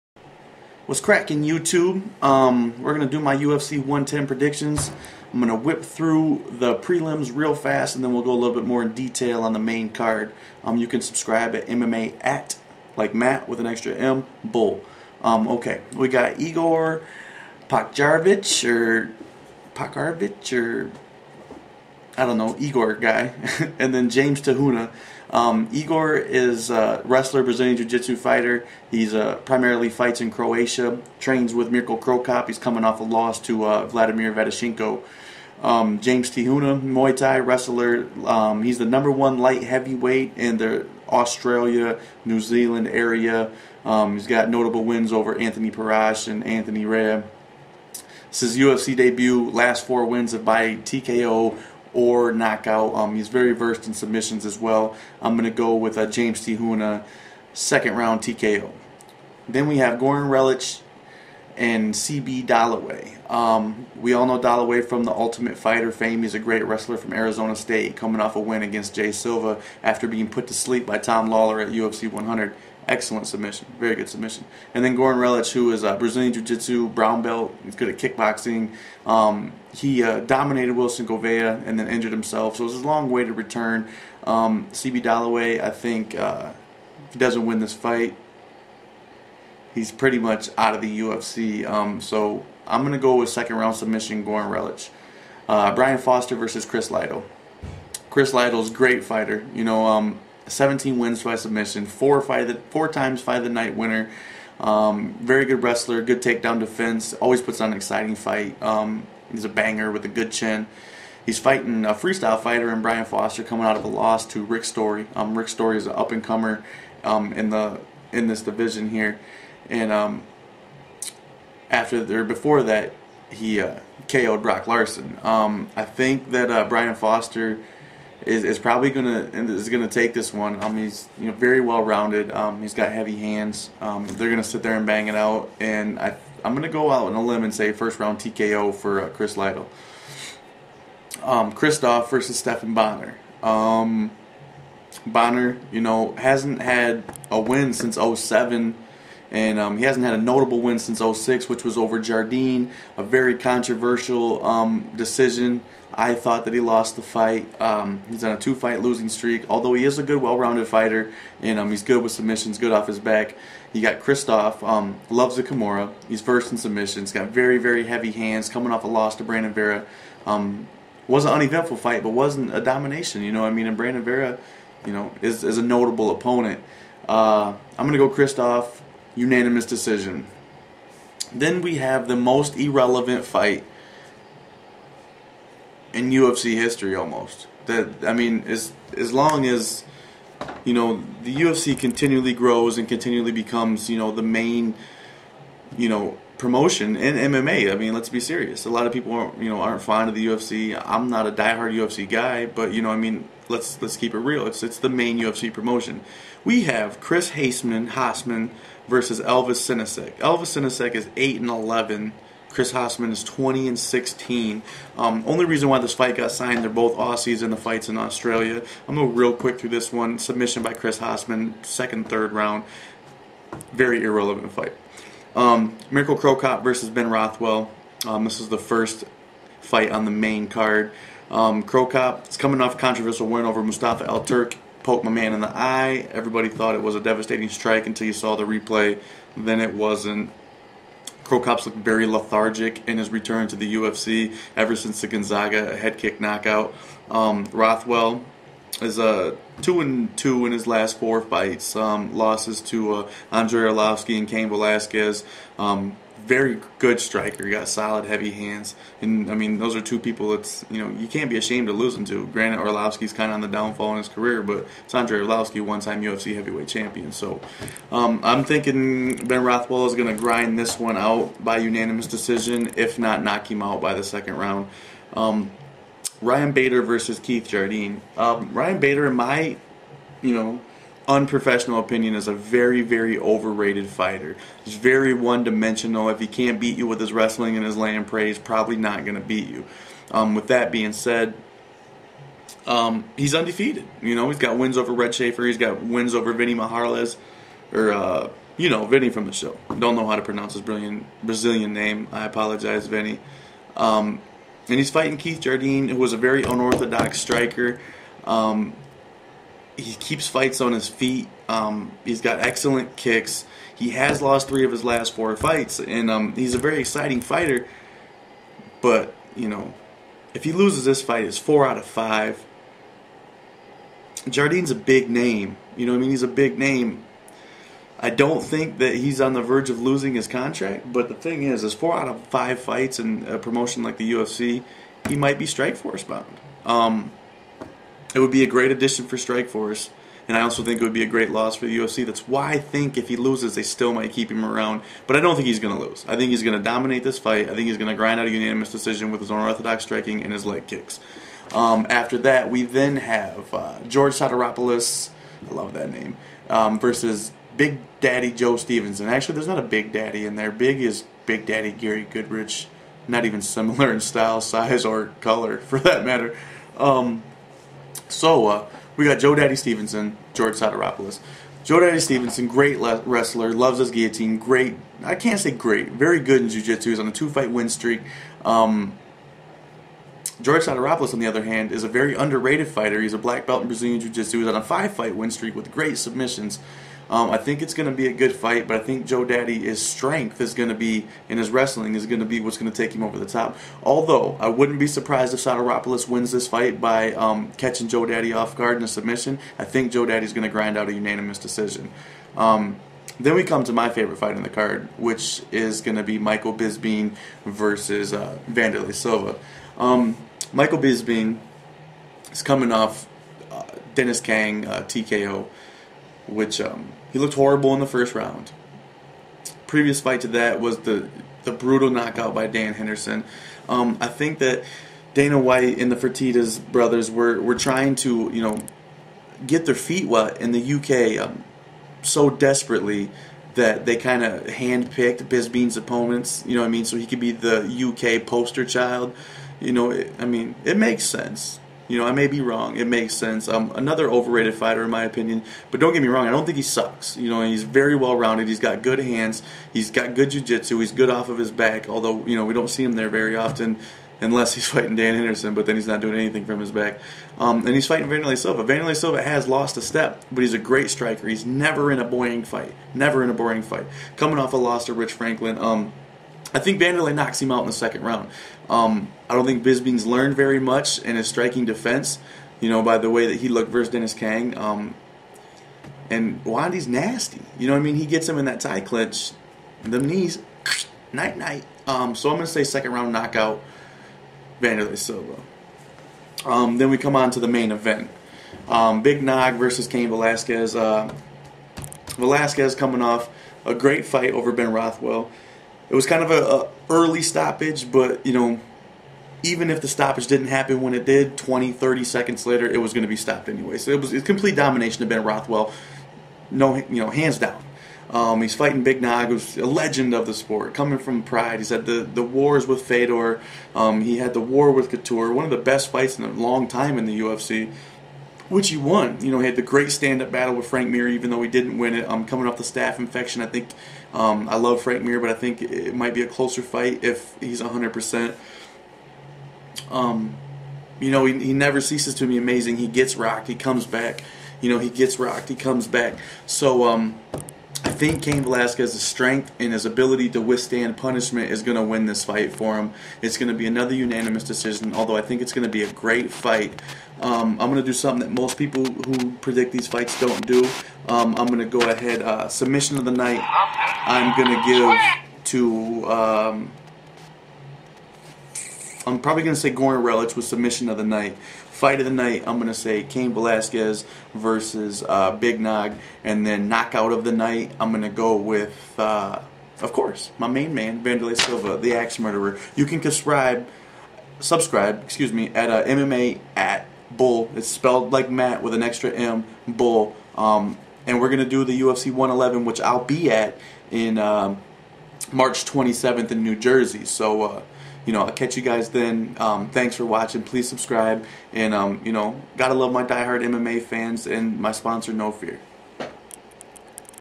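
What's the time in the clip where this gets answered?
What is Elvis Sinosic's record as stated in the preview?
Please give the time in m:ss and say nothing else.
3:31.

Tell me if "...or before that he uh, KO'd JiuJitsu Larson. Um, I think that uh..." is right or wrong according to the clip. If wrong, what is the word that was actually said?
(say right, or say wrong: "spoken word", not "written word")
wrong: "Brock", not "JiuJitsu".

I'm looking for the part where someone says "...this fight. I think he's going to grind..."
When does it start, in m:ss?
5:47.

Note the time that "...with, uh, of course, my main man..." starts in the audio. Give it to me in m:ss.
9:28.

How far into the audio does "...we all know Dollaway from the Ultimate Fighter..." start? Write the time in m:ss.
1:03.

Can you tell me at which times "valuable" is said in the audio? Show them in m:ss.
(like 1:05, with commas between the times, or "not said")
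not said.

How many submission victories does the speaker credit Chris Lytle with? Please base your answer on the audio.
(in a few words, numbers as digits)
17.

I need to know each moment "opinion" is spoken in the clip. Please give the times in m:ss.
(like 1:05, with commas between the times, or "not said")
4:41, 7:25.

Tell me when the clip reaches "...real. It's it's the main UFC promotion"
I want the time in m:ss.
3:24.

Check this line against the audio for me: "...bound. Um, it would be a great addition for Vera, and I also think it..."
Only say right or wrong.
wrong.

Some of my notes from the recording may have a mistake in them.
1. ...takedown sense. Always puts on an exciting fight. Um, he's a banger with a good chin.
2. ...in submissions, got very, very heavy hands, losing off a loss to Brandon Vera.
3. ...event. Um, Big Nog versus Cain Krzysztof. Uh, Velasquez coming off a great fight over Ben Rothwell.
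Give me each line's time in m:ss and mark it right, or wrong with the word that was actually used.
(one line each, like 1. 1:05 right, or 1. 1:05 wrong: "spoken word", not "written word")
1. 1:46 wrong: "defense", not "sense"
2. 2:46 wrong: "coming", not "losing"
3. 8:07 wrong: "Velasquez", not "Krzysztof".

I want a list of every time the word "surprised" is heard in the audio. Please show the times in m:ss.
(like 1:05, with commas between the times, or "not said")
6:34.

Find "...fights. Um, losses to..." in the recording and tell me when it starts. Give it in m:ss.
4:11.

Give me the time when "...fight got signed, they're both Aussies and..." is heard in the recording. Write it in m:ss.
3:35.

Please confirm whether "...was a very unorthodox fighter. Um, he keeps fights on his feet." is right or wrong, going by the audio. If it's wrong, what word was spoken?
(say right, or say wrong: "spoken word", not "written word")
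wrong: "striker", not "fighter".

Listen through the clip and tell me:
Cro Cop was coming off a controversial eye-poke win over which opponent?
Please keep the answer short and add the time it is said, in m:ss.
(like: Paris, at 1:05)
Mustafa El Turk, at 3:53.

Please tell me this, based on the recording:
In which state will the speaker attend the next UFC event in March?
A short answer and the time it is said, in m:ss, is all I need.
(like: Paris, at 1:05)
New Jersey, at 9:46.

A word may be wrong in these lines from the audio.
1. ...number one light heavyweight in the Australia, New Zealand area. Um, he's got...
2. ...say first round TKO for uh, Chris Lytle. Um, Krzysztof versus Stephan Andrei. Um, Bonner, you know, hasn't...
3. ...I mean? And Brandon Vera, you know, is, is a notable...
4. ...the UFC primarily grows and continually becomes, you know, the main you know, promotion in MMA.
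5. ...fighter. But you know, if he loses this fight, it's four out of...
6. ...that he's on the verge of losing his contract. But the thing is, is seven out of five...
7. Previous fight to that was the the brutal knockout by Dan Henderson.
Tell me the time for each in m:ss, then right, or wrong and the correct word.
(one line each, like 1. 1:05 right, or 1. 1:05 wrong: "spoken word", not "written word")
1. 0:38 right
2. 2:17 wrong: "Bonnar", not "Andrei"
3. 2:53 right
4. 3:11 wrong: "continually", not "primarily"
5. 5:17 right
6. 5:28 wrong: "four", not "seven"
7. 6:59 right.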